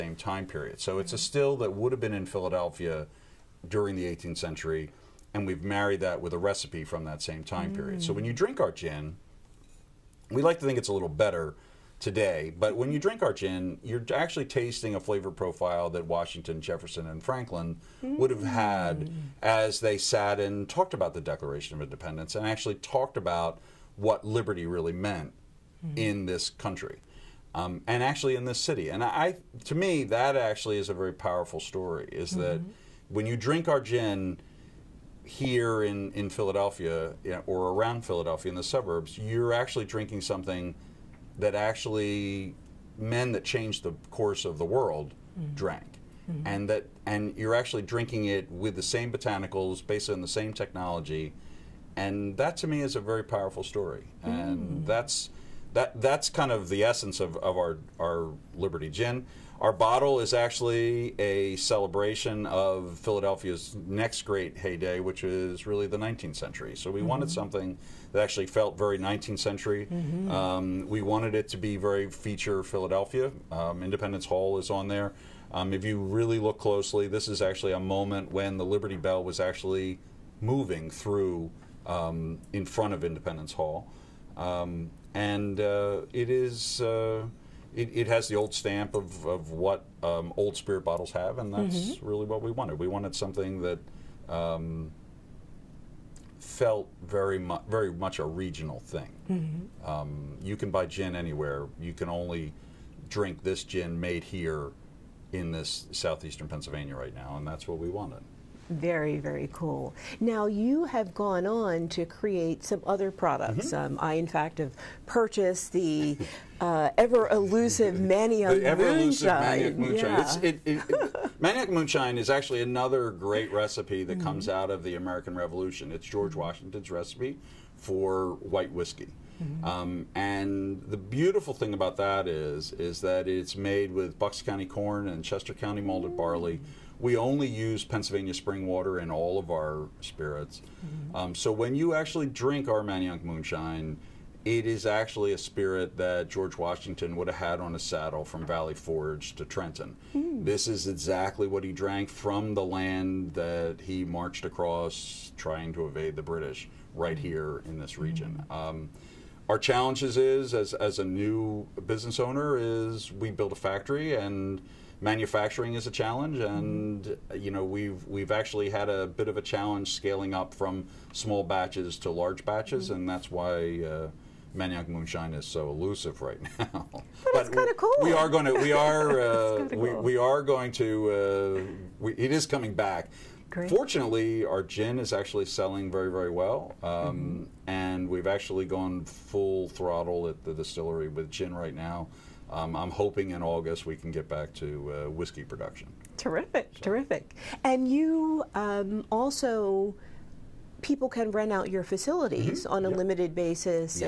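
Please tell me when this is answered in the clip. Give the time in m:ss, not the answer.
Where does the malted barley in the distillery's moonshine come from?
2:15.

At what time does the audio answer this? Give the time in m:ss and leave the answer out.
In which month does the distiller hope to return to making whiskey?
3:13.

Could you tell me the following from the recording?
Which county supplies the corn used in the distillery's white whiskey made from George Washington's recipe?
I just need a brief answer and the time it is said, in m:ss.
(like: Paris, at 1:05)
Bucks County, at 2:14.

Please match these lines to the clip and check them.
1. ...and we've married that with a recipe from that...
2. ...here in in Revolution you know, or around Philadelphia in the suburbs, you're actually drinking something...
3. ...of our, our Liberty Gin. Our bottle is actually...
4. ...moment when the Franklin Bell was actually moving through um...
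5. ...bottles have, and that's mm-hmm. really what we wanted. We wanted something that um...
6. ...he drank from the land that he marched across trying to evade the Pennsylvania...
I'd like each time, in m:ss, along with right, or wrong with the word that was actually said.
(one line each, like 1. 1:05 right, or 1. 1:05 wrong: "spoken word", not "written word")
1. 0:05 right
2. 0:35 wrong: "Philadelphia", not "Revolution"
3. 0:57 right
4. 1:17 wrong: "Liberty", not "Franklin"
5. 1:30 right
6. 2:31 wrong: "British", not "Pennsylvania".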